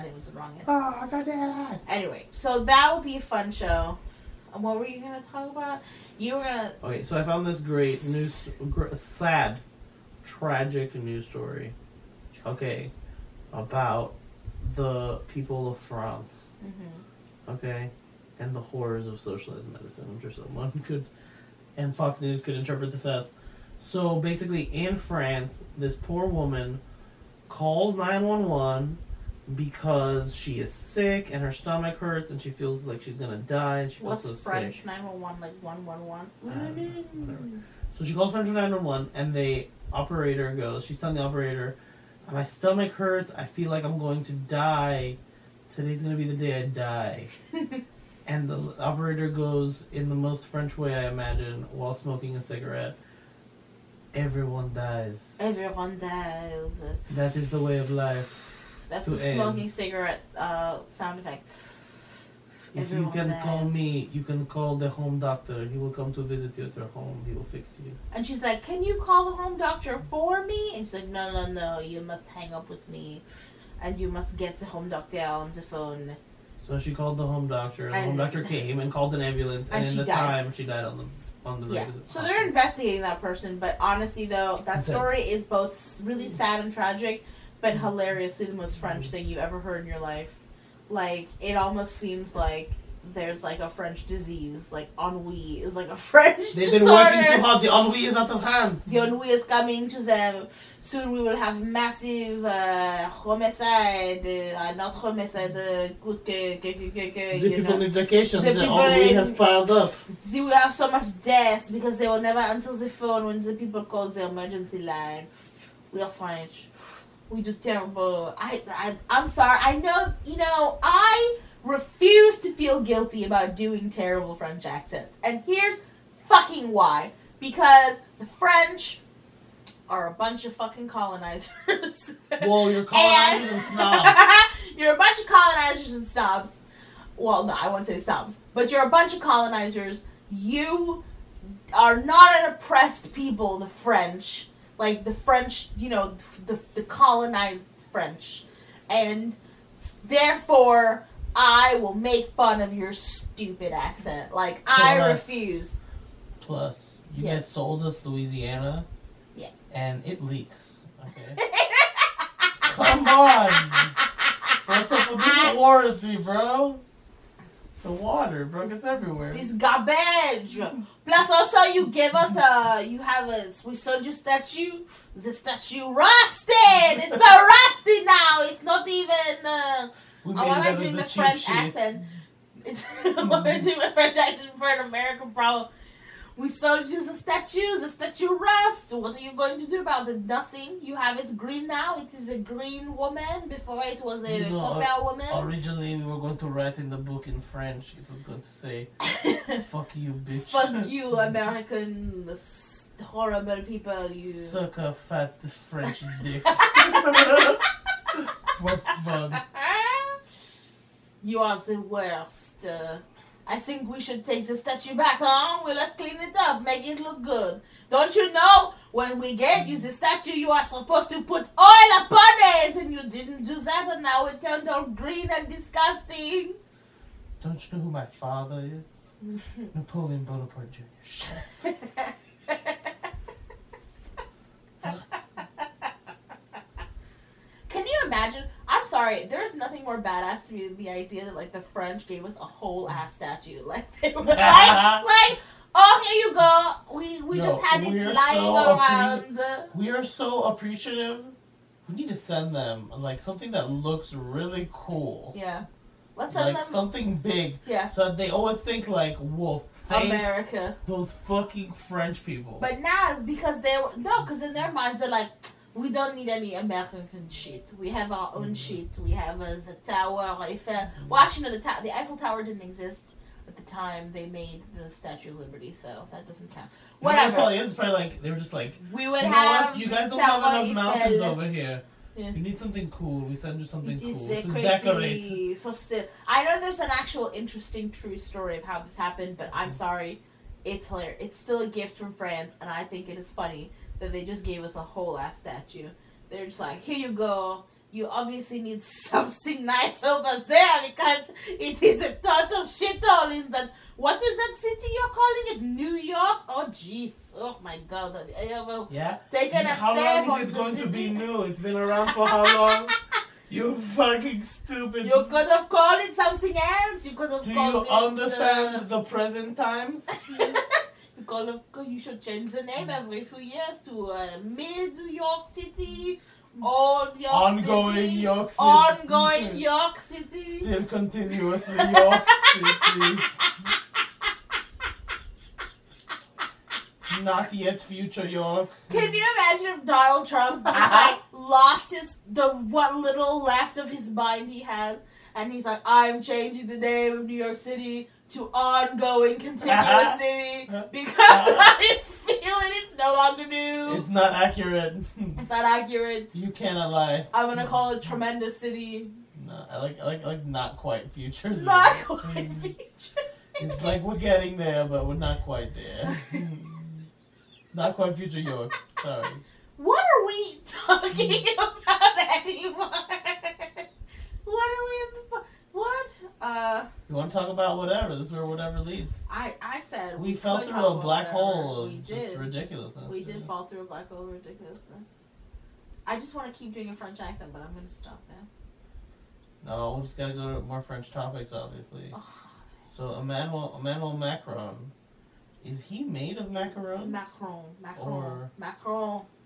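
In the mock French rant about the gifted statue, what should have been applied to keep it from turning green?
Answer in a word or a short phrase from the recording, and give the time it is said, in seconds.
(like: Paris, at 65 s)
oil, at 221 s.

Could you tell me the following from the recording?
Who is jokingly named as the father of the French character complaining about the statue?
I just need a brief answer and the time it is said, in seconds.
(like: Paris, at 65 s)
Napoleon Bonaparte Jr., at 229 s.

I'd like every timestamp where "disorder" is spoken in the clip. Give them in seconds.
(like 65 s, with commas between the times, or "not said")
96 s.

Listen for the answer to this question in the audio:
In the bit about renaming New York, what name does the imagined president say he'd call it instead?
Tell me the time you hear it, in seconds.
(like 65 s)
358 s.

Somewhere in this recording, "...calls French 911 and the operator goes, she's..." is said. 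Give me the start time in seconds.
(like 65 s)
38 s.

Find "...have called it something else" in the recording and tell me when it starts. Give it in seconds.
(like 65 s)
315 s.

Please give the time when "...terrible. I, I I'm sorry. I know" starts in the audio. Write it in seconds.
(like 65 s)
117 s.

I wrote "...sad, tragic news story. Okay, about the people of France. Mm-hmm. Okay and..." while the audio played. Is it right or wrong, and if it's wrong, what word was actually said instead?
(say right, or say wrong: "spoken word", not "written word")
right.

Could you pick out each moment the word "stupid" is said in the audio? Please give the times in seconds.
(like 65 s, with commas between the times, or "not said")
152 s, 314 s.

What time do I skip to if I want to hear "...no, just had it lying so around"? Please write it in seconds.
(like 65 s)
247 s.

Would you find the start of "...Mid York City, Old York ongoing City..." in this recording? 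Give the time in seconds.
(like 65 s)
324 s.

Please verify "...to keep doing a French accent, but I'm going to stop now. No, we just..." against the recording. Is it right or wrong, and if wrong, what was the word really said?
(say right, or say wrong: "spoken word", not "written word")
right.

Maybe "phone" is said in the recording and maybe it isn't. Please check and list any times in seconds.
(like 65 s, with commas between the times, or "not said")
75 s, 112 s.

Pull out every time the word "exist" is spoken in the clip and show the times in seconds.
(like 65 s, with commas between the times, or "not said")
272 s.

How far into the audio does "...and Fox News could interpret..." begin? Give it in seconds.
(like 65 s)
21 s.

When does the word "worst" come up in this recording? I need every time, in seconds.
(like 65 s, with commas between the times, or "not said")
211 s.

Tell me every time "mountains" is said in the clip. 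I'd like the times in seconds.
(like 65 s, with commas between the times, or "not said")
280 s.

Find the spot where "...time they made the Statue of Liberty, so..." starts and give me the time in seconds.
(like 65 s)
273 s.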